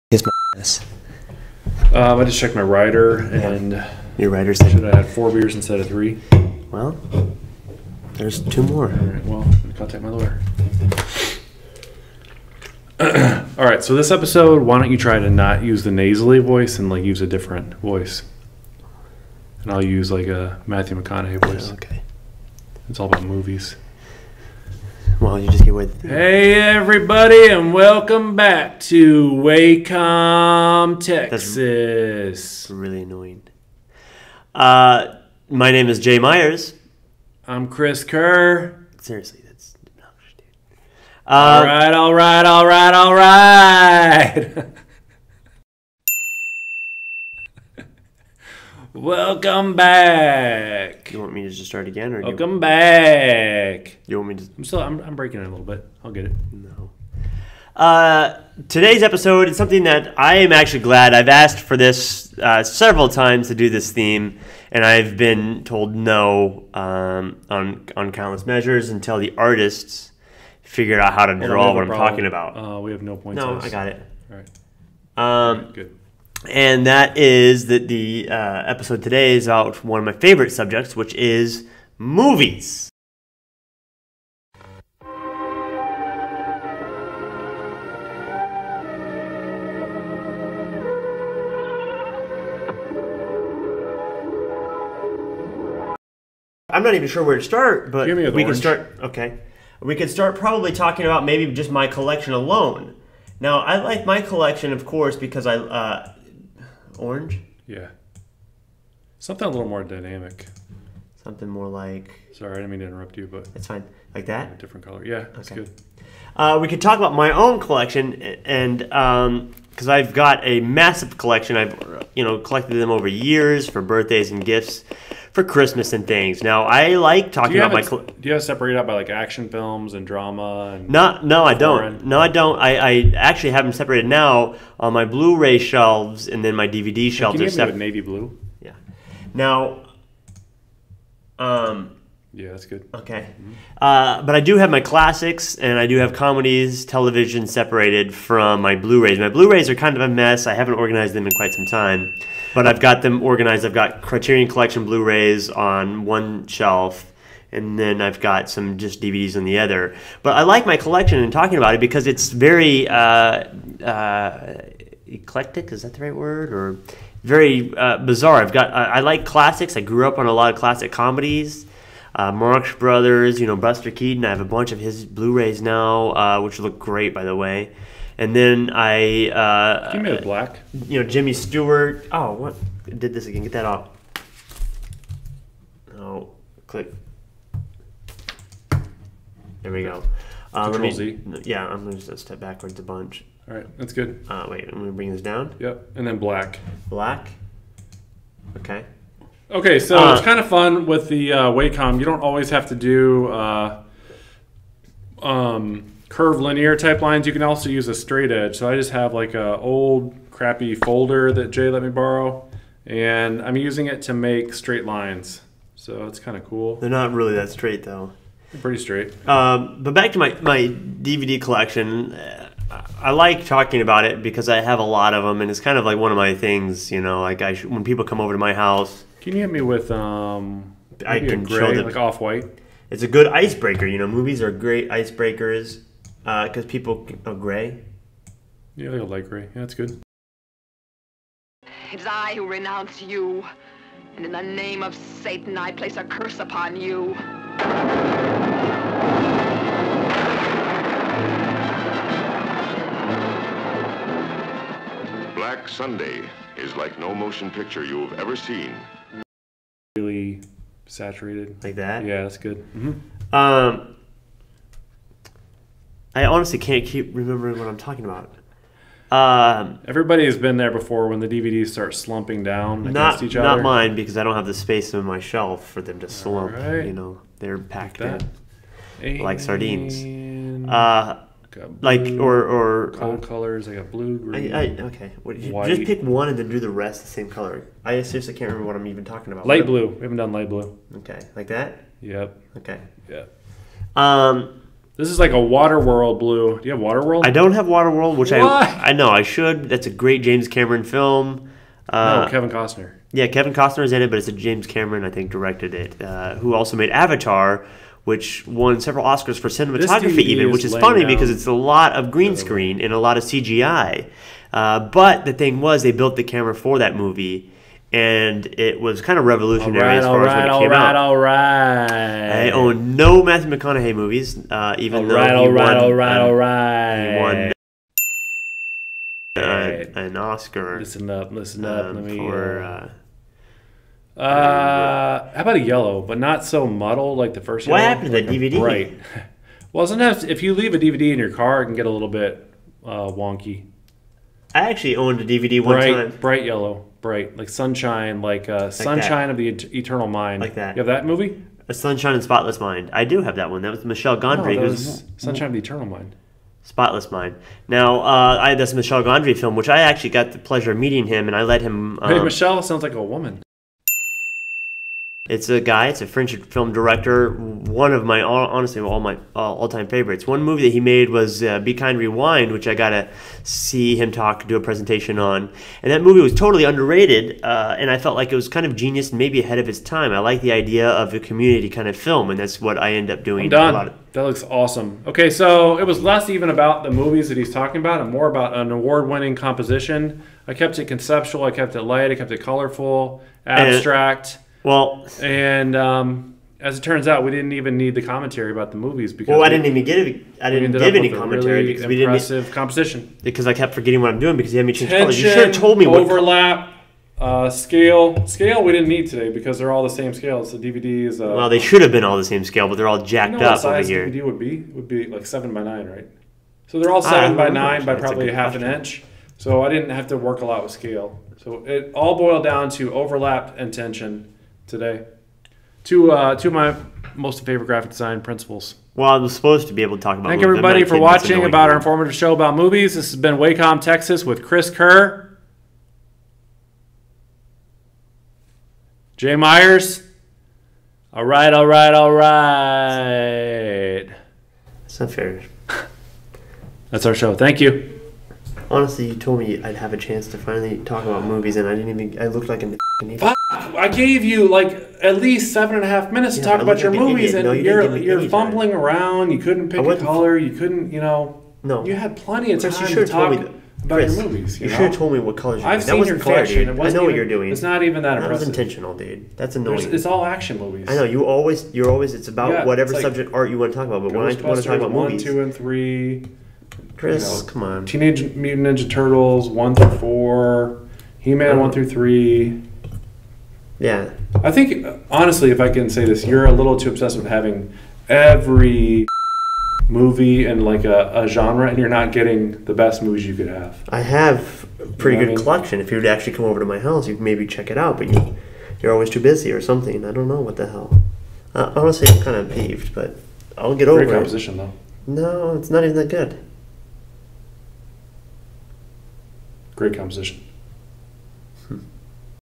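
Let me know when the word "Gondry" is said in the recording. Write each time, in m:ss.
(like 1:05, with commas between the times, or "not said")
5:54, 5:59.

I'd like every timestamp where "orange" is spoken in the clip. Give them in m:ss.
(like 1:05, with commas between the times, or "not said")
1:38, 1:46.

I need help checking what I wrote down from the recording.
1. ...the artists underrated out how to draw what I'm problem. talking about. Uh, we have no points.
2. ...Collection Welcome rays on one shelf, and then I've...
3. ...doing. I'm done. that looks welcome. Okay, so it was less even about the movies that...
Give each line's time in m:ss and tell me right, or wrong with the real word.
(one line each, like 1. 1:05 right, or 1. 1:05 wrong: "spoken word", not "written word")
1. 1:09 wrong: "figured", not "underrated"
2. 2:34 wrong: "Blu", not "Welcome"
3. 6:23 wrong: "awesome", not "welcome".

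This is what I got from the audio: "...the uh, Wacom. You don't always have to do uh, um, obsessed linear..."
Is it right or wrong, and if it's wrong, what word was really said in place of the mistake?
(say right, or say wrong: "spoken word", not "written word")
wrong: "curved", not "obsessed".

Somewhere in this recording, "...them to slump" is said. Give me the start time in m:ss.
4:35.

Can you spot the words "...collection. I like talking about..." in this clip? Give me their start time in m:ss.
3:41.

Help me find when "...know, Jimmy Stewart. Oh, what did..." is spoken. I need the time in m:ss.
3:01.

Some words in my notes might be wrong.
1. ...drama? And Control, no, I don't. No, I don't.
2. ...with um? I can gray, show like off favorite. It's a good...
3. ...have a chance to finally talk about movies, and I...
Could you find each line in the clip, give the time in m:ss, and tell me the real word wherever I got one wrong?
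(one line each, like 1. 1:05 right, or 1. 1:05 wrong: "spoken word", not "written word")
1. 2:10 wrong: "Not", not "Control"
2. 3:49 wrong: "white", not "favorite"
3. 7:29 right.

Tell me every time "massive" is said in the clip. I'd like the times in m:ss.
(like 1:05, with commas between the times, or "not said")
2:00.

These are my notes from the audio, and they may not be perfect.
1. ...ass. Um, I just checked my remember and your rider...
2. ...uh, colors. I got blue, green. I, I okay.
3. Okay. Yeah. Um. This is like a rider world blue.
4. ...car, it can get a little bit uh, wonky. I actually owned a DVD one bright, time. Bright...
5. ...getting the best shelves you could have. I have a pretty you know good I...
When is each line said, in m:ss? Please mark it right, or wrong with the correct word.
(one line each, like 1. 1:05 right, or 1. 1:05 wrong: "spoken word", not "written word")
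1. 0:00 wrong: "rider", not "remember"
2. 4:43 right
3. 4:52 wrong: "water", not "rider"
4. 5:41 right
5. 8:12 wrong: "movies", not "shelves".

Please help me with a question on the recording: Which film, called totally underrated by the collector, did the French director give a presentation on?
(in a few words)
Be Kind Rewind.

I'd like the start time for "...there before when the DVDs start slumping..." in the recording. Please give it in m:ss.
4:30.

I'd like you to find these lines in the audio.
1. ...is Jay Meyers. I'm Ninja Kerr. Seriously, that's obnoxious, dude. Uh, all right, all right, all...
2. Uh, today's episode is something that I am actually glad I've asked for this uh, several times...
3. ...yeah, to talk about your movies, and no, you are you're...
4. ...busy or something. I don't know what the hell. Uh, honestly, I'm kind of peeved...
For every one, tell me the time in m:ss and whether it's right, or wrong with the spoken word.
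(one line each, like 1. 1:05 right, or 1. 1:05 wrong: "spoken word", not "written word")
1. 0:35 wrong: "Chris", not "Ninja"
2. 0:57 right
3. 7:36 right
4. 8:19 right.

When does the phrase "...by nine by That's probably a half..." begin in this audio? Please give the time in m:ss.
6:57.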